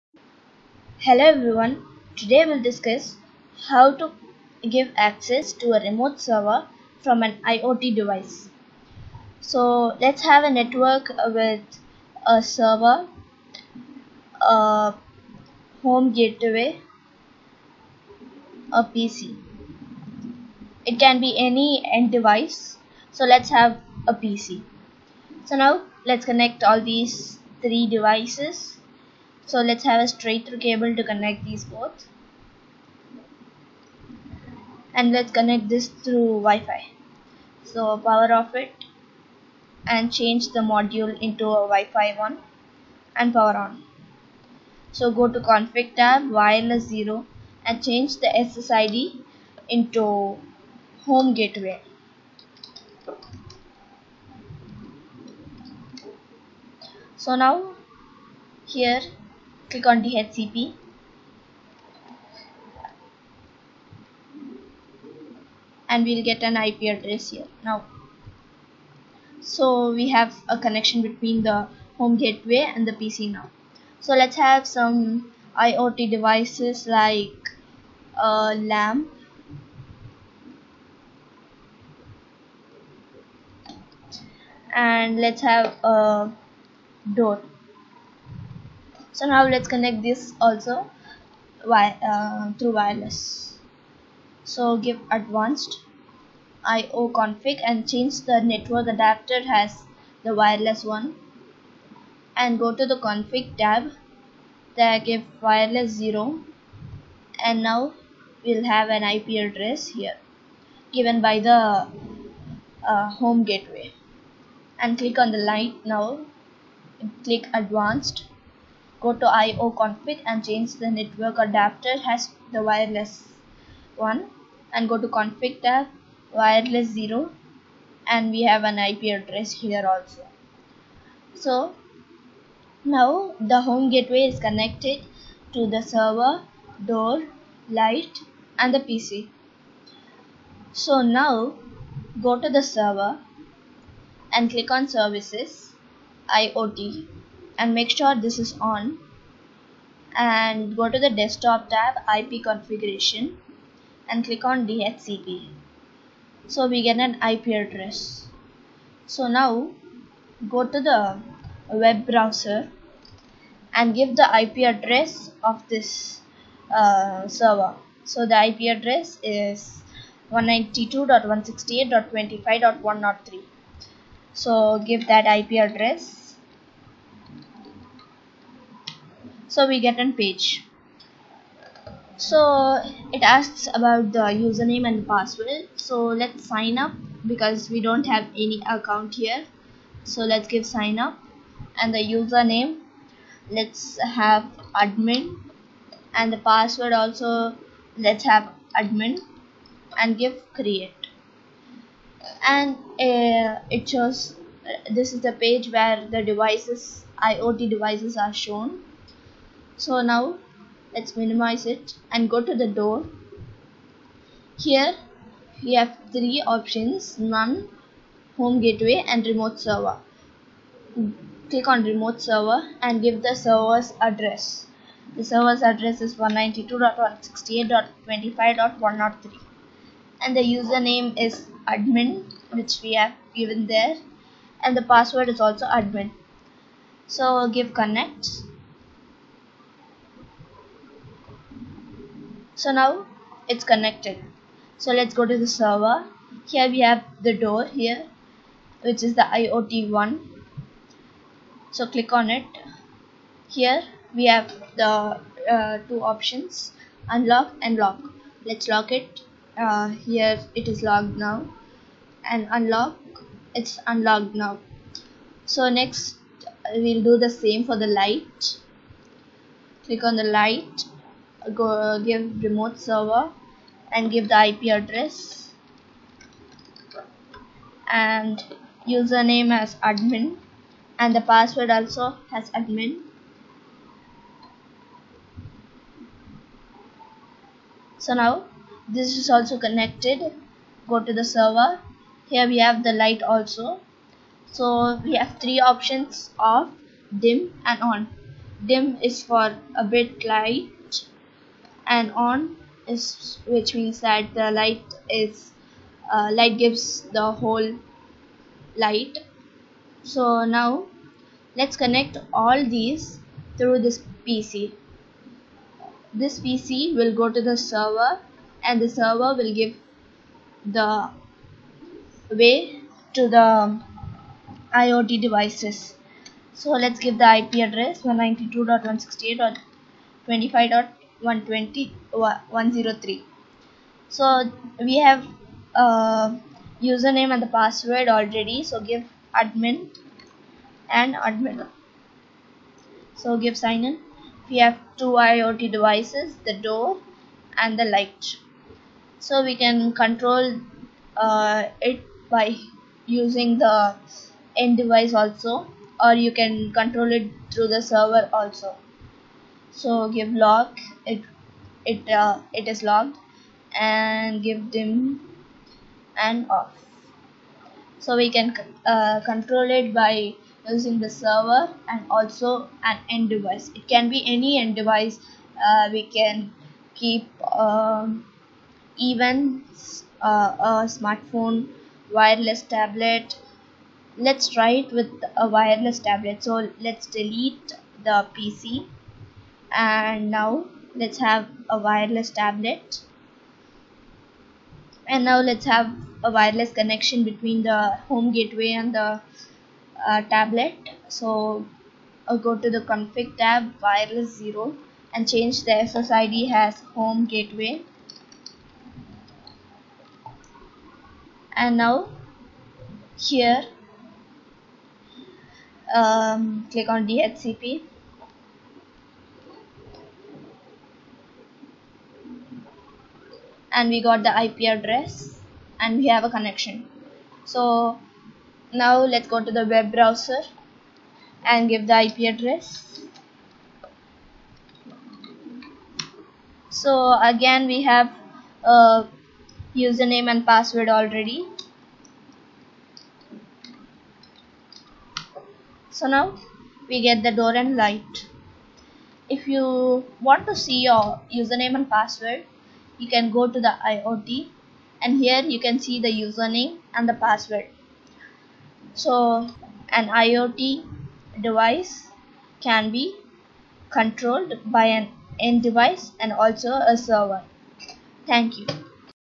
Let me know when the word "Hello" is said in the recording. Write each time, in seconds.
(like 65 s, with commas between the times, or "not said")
1 s.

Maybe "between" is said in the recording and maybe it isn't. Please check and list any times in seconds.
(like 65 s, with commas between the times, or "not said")
71 s, 397 s.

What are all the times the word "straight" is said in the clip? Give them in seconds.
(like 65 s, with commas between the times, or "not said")
30 s.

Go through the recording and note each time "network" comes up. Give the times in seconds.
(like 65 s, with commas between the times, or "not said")
10 s, 98 s, 120 s.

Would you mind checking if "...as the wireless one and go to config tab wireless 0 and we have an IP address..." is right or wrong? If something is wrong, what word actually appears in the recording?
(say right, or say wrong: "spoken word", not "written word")
right.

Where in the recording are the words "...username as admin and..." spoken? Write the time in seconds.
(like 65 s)
278 s.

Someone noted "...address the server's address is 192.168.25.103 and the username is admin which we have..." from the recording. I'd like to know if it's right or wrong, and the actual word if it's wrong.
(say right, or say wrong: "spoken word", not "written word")
right.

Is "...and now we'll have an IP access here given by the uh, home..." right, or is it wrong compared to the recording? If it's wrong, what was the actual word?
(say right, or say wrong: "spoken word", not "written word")
wrong: "address", not "access".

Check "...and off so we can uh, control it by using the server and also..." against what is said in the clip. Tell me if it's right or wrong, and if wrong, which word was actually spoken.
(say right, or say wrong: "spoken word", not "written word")
right.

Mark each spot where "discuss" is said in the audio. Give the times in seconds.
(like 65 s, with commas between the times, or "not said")
2 s.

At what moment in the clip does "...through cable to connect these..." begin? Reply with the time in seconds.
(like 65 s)
30 s.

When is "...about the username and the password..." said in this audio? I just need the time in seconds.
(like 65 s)
183 s.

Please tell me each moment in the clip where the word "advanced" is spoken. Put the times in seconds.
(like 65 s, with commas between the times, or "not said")
95 s, 117 s.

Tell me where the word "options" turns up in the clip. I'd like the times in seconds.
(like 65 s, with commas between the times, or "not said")
216 s, 256 s, 295 s.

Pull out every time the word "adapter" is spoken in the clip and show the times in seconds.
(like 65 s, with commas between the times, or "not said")
98 s, 121 s.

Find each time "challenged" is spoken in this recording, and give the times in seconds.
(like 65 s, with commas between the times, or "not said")
not said.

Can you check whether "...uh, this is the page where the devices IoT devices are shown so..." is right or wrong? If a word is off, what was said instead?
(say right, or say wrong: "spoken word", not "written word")
right.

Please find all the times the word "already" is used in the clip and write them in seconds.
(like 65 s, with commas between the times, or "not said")
338 s, 440 s.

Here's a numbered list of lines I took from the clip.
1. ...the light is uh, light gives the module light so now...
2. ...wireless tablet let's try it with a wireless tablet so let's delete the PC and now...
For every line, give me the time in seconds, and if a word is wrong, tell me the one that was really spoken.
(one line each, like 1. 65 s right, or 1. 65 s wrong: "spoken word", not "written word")
1. 304 s wrong: "whole", not "module"
2. 382 s right.